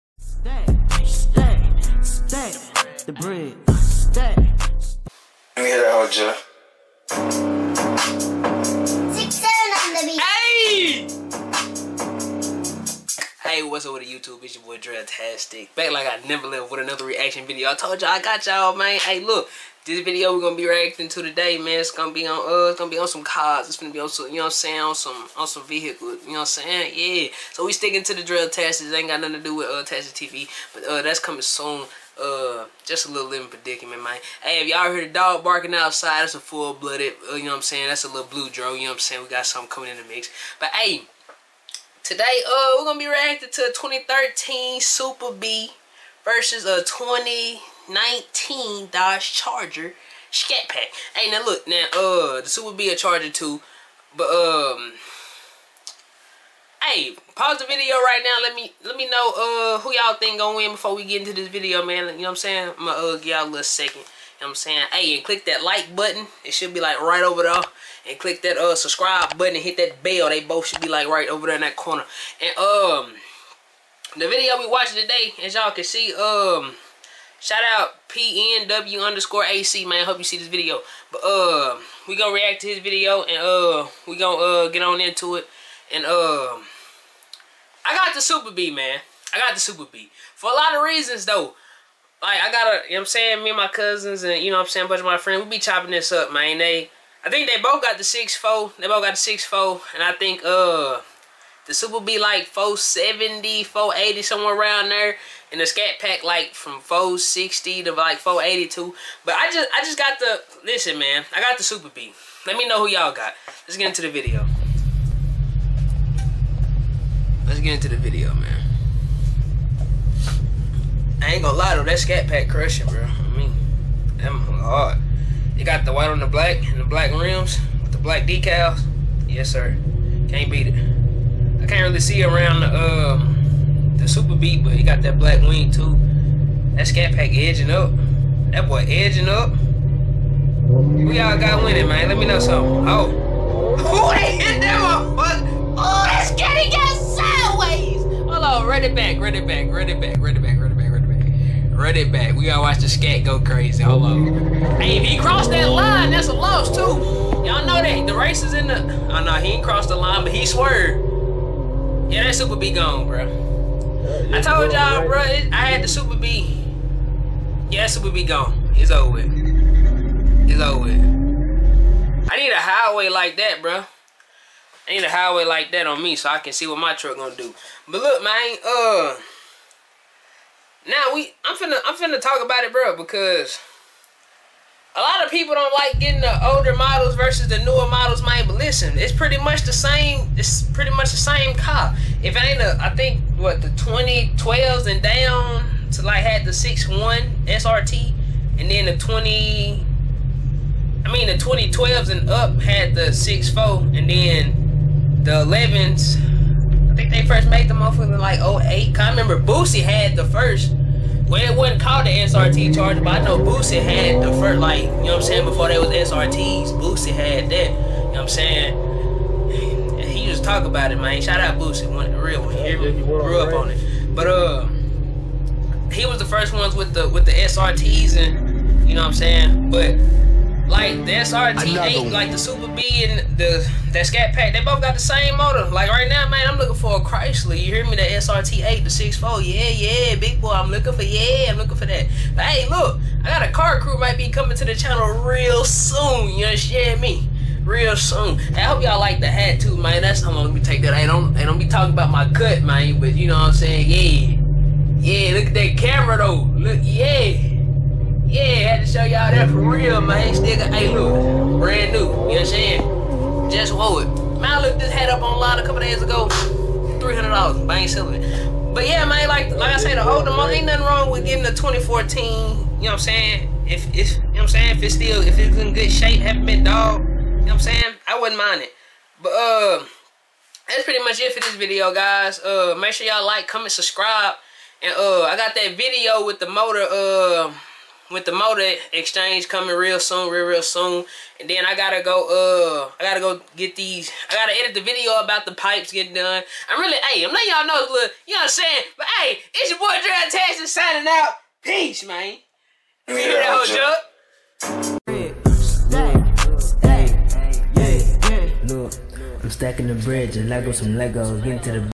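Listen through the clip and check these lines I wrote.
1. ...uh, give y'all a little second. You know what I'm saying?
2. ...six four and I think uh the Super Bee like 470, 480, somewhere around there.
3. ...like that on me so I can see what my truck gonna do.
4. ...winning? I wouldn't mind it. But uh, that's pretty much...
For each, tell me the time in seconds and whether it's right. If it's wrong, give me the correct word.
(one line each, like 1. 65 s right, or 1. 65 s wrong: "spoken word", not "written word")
1. 63 s right
2. 99 s right
3. 175 s right
4. 277 s wrong: "saying", not "winning".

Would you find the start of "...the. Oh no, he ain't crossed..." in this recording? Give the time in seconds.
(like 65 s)
158 s.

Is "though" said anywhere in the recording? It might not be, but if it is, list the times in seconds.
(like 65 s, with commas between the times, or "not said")
91 s, 121 s, 256 s.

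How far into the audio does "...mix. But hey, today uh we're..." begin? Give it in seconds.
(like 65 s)
40 s.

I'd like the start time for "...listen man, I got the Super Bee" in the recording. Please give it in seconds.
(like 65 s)
110 s.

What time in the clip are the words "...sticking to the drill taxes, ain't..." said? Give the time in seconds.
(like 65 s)
27 s.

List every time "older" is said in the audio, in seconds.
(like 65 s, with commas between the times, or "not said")
186 s, 270 s.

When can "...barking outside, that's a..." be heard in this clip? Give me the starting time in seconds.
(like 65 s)
35 s.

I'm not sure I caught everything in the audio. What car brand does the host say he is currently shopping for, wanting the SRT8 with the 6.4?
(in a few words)
Chrysler.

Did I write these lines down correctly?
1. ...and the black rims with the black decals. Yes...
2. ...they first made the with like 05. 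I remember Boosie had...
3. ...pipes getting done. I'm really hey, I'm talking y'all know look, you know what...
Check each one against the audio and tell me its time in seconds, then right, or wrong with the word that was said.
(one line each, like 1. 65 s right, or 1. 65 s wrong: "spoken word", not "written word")
1. 126 s right
2. 207 s wrong: "08", not "05"
3. 295 s wrong: "letting", not "talking".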